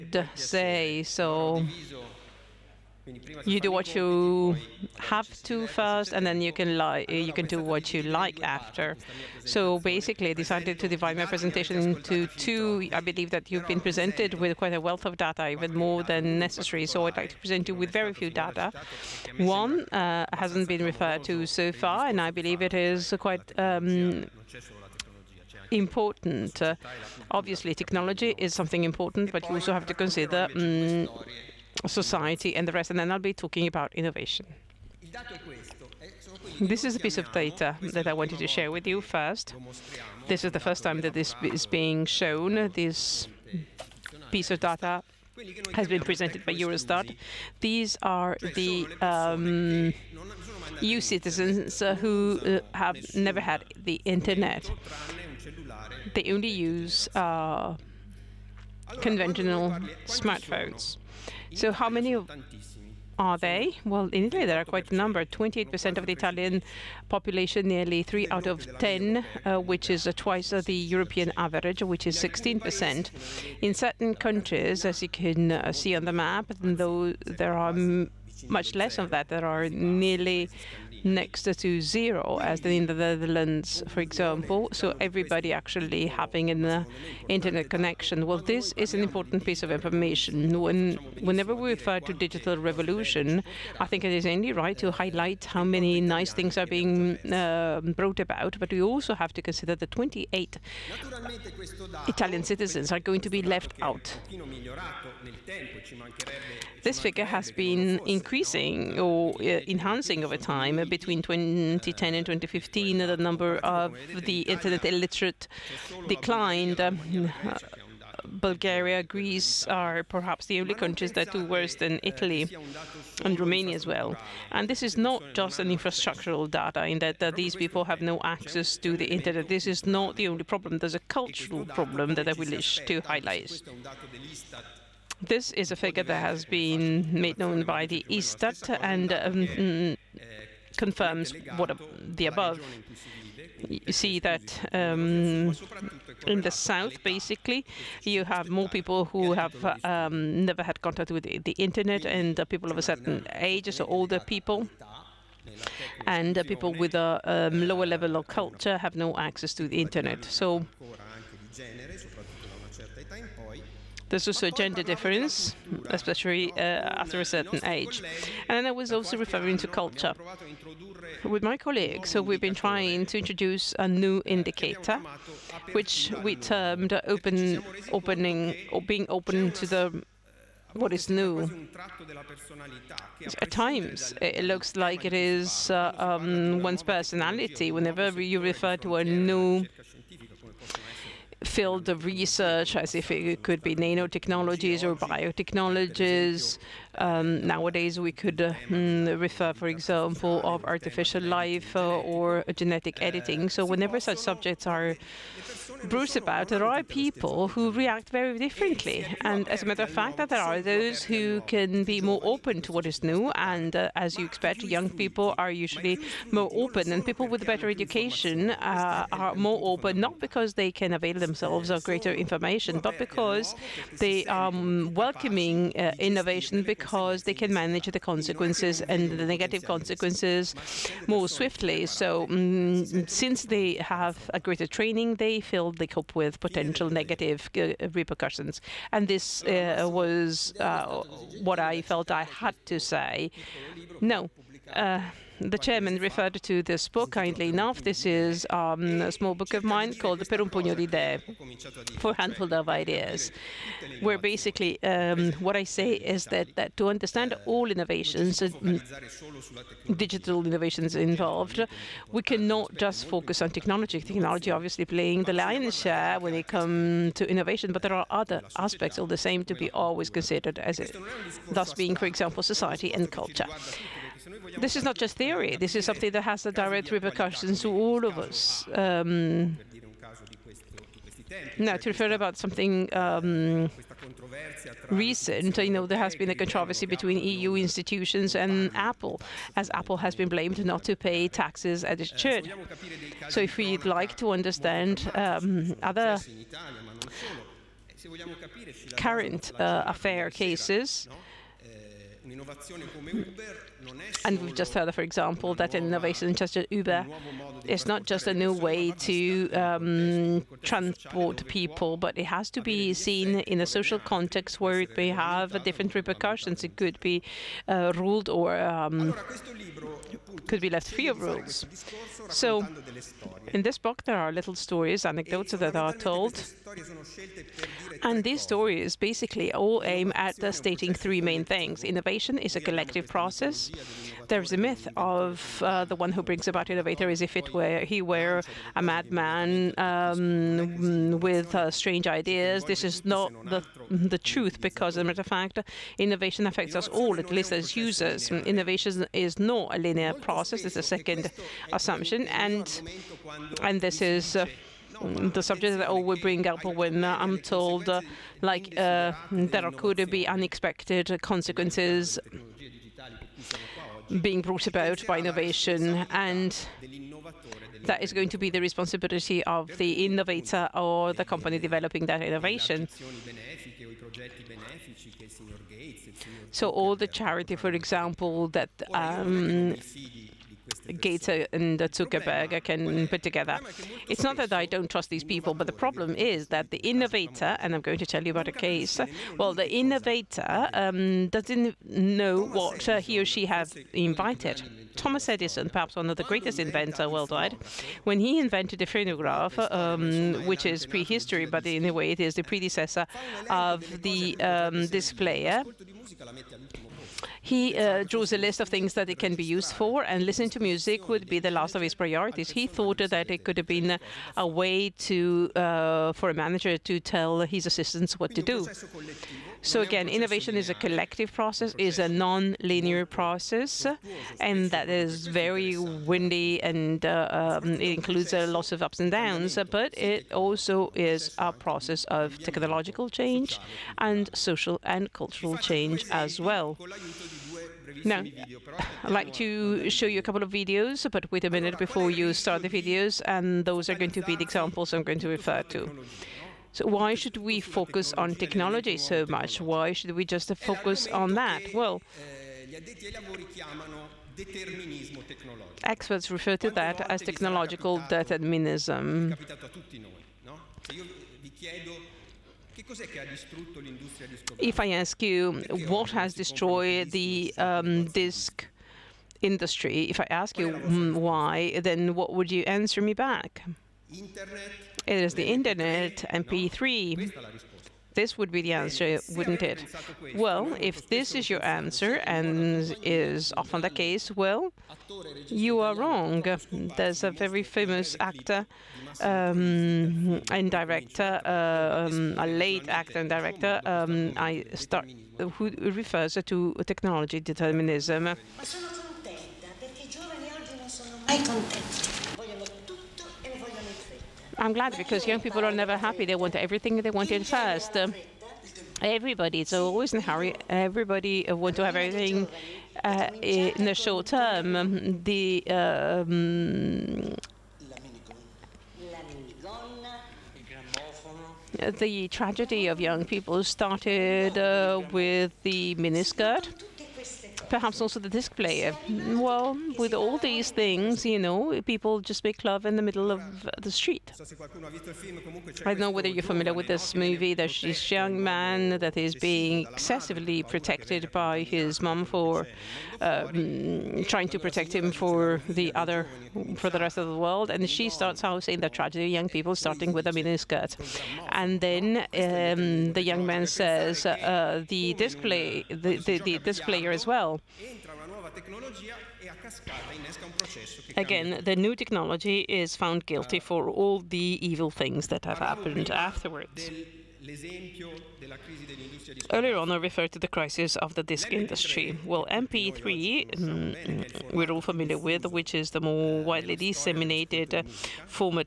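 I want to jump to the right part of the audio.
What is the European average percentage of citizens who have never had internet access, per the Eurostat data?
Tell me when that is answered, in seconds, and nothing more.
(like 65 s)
72 s.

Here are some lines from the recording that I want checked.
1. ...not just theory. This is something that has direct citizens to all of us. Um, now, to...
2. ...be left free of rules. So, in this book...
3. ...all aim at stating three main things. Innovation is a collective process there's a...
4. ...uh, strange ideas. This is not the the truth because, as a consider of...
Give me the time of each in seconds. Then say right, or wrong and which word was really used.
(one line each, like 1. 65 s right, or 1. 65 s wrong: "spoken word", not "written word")
1. 274 s wrong: "repercussions", not "citizens"
2. 320 s right
3. 329 s right
4. 341 s wrong: "matter", not "consider".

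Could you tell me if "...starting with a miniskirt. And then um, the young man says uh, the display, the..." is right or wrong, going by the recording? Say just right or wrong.
right.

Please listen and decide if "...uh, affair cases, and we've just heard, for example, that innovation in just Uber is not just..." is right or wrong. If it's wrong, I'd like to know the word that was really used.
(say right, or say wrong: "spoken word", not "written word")
right.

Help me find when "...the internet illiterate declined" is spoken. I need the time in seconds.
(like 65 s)
114 s.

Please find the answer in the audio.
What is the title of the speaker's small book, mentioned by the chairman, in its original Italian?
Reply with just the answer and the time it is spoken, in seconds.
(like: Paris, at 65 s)
Per un pugno di idee, at 250 s.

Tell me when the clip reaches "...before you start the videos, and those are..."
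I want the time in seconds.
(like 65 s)
441 s.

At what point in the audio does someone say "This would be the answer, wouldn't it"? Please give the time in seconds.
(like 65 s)
478 s.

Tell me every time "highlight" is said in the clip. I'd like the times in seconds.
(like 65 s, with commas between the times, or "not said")
94 s, 133 s.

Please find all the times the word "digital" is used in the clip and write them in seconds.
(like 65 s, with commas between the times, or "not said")
92 s, 259 s.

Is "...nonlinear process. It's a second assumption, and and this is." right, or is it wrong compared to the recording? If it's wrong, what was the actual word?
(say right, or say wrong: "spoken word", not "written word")
wrong: "linear", not "nonlinear".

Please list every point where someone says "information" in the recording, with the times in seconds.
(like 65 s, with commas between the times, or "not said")
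89 s, 222 s.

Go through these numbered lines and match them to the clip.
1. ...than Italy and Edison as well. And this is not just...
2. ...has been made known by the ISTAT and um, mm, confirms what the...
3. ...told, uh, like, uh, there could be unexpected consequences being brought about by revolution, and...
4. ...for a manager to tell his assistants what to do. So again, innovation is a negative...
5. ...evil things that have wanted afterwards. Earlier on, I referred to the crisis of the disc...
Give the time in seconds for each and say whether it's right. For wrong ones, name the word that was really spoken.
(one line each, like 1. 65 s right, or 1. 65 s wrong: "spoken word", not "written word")
1. 121 s wrong: "Romania", not "Edison"
2. 136 s right
3. 357 s wrong: "innovation", not "revolution"
4. 416 s wrong: "collective", not "negative"
5. 564 s wrong: "happened", not "wanted".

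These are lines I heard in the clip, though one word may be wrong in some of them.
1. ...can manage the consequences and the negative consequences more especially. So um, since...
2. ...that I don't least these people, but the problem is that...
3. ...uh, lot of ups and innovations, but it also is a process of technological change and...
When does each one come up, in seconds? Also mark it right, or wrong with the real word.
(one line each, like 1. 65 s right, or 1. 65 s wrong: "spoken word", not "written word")
1. 227 s wrong: "swiftly", not "especially"
2. 384 s wrong: "trust", not "least"
3. 428 s wrong: "downs", not "innovations".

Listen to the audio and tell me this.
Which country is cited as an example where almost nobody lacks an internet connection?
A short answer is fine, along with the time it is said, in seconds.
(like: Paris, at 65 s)
Netherlands, at 82 s.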